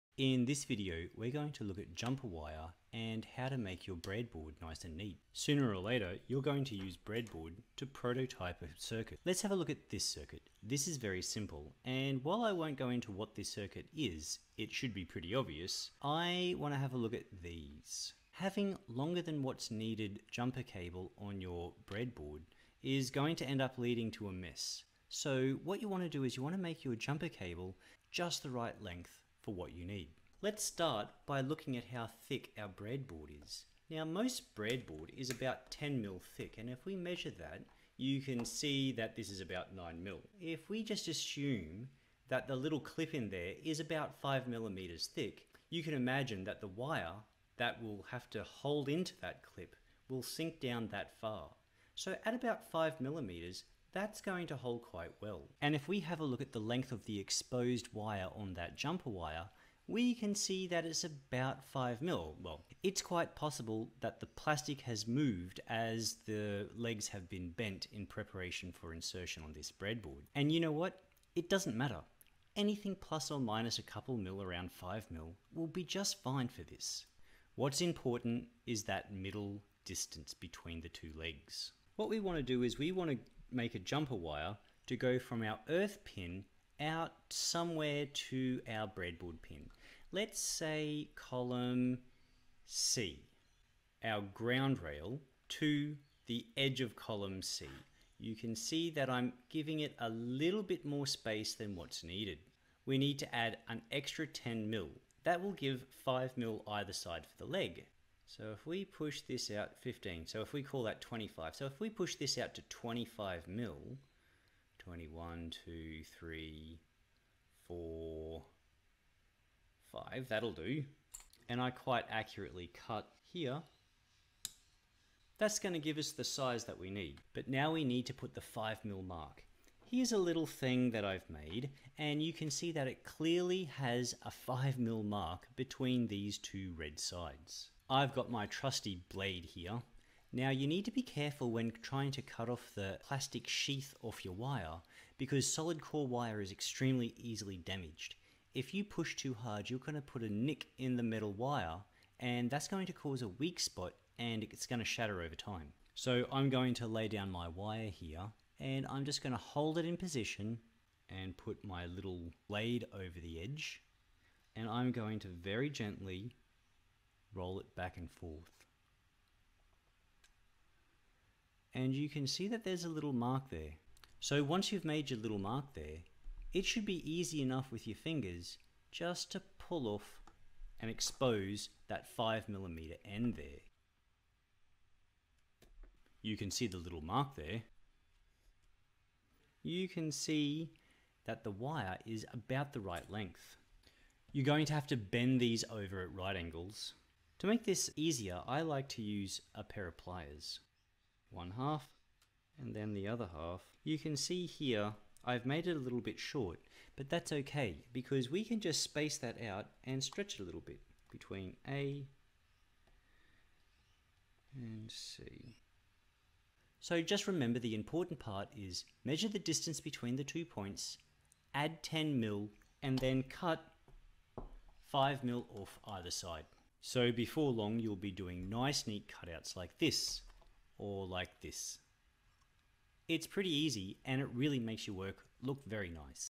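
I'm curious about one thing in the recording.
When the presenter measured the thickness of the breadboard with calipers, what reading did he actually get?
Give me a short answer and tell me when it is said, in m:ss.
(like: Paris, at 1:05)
9 mm, at 0:39.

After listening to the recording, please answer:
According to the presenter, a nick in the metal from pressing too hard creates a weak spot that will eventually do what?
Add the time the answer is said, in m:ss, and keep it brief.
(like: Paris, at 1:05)
shatter, at 2:34.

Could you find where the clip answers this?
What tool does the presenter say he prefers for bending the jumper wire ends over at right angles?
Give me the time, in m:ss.
3:19.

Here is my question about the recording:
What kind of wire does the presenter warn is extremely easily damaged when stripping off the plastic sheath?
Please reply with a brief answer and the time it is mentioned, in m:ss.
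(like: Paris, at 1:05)
solid core wire, at 2:25.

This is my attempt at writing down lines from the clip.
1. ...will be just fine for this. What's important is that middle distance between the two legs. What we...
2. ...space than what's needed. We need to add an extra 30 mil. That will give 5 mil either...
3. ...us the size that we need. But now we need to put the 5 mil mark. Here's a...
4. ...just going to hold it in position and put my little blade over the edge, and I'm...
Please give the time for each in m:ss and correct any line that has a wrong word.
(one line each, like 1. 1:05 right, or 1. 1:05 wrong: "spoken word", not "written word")
1. 1:15 right
2. 1:41 wrong: "10", not "30"
3. 2:05 right
4. 2:39 right.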